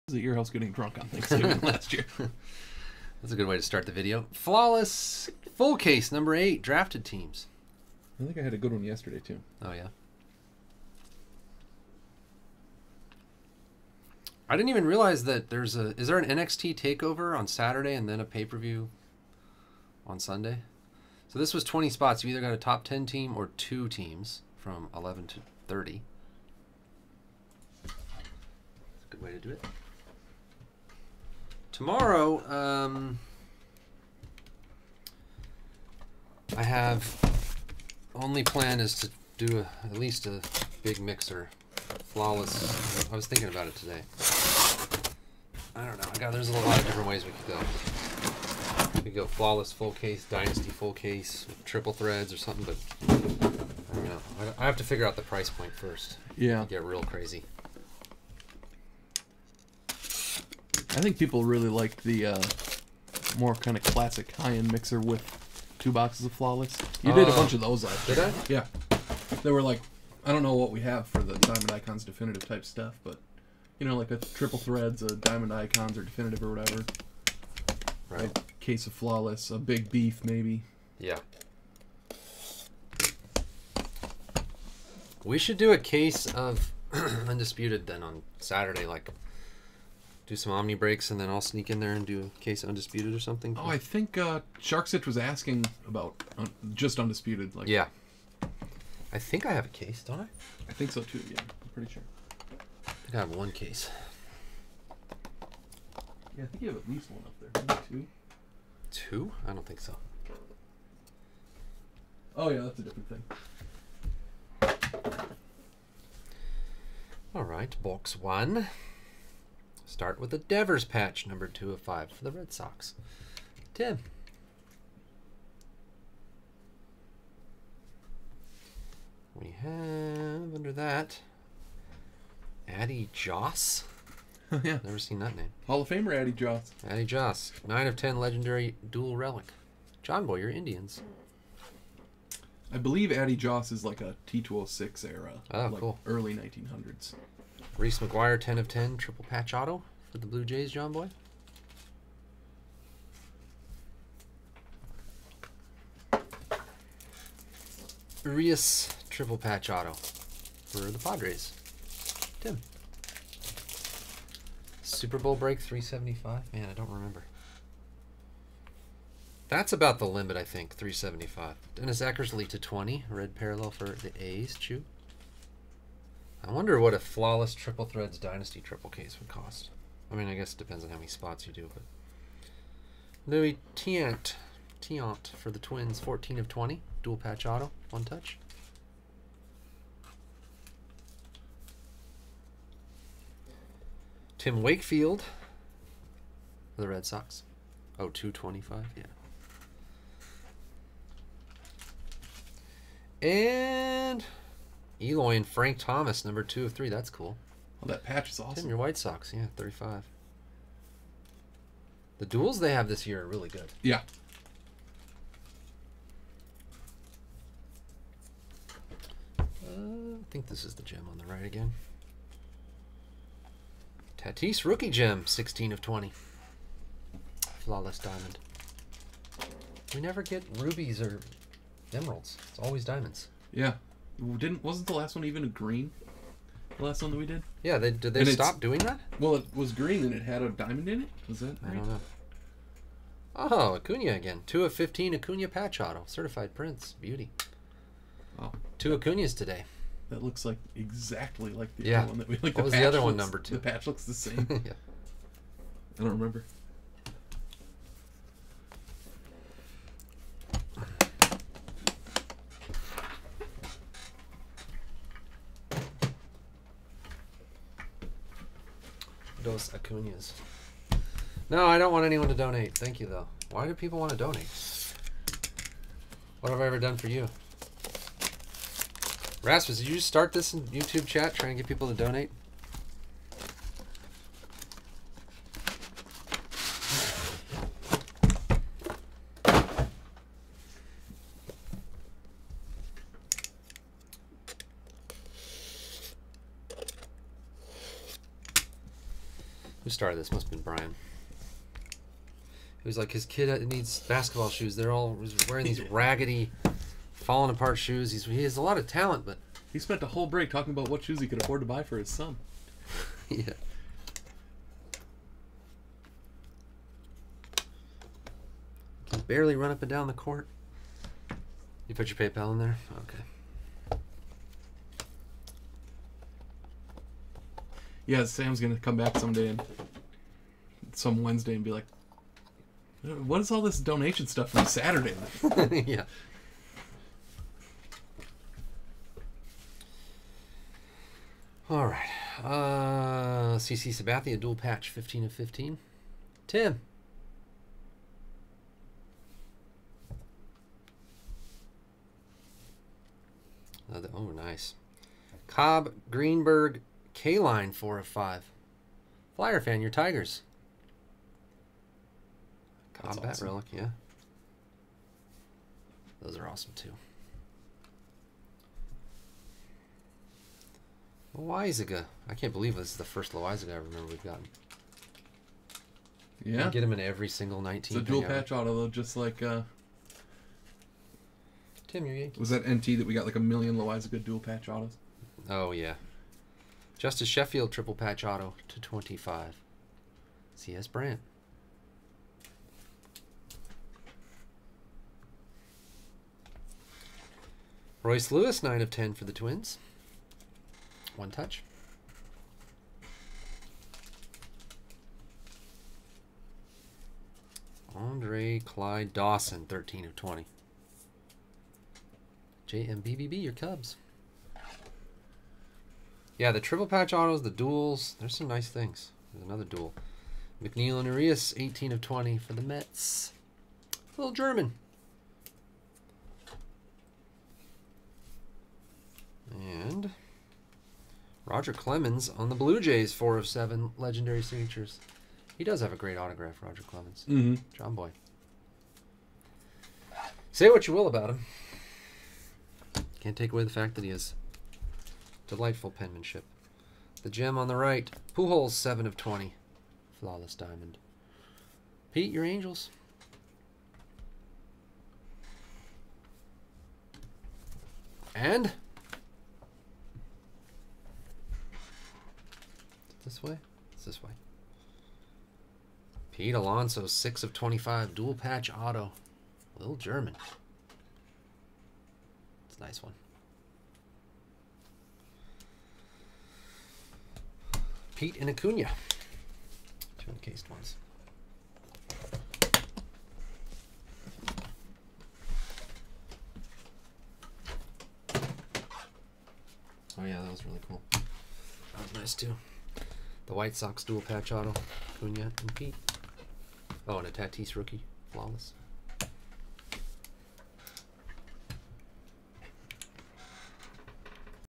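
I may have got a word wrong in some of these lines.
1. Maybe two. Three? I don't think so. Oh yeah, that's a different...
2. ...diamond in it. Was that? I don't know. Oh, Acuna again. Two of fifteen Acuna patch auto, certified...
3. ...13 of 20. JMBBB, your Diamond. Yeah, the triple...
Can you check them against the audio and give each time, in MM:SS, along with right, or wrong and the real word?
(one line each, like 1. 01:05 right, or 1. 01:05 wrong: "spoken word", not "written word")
1. 01:47 wrong: "Two", not "Three"
2. 04:00 right
3. 06:49 wrong: "Cubs", not "Diamond".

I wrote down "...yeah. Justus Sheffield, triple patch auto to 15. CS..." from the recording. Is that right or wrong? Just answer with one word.
wrong.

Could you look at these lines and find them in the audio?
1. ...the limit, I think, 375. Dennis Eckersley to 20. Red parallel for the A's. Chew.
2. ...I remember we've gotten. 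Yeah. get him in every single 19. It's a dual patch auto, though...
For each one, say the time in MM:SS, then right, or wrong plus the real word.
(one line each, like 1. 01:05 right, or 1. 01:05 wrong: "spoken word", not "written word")
1. 02:49 right
2. 06:13 right.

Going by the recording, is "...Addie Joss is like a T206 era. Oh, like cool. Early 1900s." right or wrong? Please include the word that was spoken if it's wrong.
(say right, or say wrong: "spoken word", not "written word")
right.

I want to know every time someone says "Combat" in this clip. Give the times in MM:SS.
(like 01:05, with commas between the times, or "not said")
06:02.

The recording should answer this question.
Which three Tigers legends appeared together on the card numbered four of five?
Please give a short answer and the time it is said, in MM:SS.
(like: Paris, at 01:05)
Cobb, Greenberg, Kaline, at 05:55.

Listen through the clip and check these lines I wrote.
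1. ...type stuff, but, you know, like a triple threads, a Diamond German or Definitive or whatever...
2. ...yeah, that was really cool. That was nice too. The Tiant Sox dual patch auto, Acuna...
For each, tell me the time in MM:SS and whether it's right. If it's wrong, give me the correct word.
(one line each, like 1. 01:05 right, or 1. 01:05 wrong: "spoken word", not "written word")
1. 01:12 wrong: "Icons", not "German"
2. 08:10 wrong: "White", not "Tiant".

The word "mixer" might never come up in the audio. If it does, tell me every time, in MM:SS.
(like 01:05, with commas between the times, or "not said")
00:40, 01:04.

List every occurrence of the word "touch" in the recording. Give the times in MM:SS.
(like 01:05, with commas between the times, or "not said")
03:08, 06:41.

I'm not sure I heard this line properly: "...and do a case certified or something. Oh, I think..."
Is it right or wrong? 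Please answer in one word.
wrong.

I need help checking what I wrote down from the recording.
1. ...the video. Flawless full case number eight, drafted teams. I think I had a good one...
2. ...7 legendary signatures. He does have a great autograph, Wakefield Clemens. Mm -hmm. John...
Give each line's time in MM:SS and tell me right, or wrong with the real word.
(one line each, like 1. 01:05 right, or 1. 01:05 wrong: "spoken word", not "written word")
1. 00:03 right
2. 07:13 wrong: "Roger", not "Wakefield".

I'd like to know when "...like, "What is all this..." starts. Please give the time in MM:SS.
05:31.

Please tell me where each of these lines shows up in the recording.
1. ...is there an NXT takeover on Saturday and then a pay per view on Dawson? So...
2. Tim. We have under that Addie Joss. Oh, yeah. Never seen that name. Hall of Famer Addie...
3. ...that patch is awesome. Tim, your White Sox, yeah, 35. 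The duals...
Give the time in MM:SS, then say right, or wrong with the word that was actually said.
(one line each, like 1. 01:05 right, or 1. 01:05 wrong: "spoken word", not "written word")
1. 00:15 wrong: "Sunday", not "Dawson"
2. 02:03 right
3. 03:27 right.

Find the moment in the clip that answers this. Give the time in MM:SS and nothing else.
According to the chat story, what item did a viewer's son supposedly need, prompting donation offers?
05:04.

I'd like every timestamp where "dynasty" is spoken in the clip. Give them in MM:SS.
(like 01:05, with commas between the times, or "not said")
00:50, 02:58.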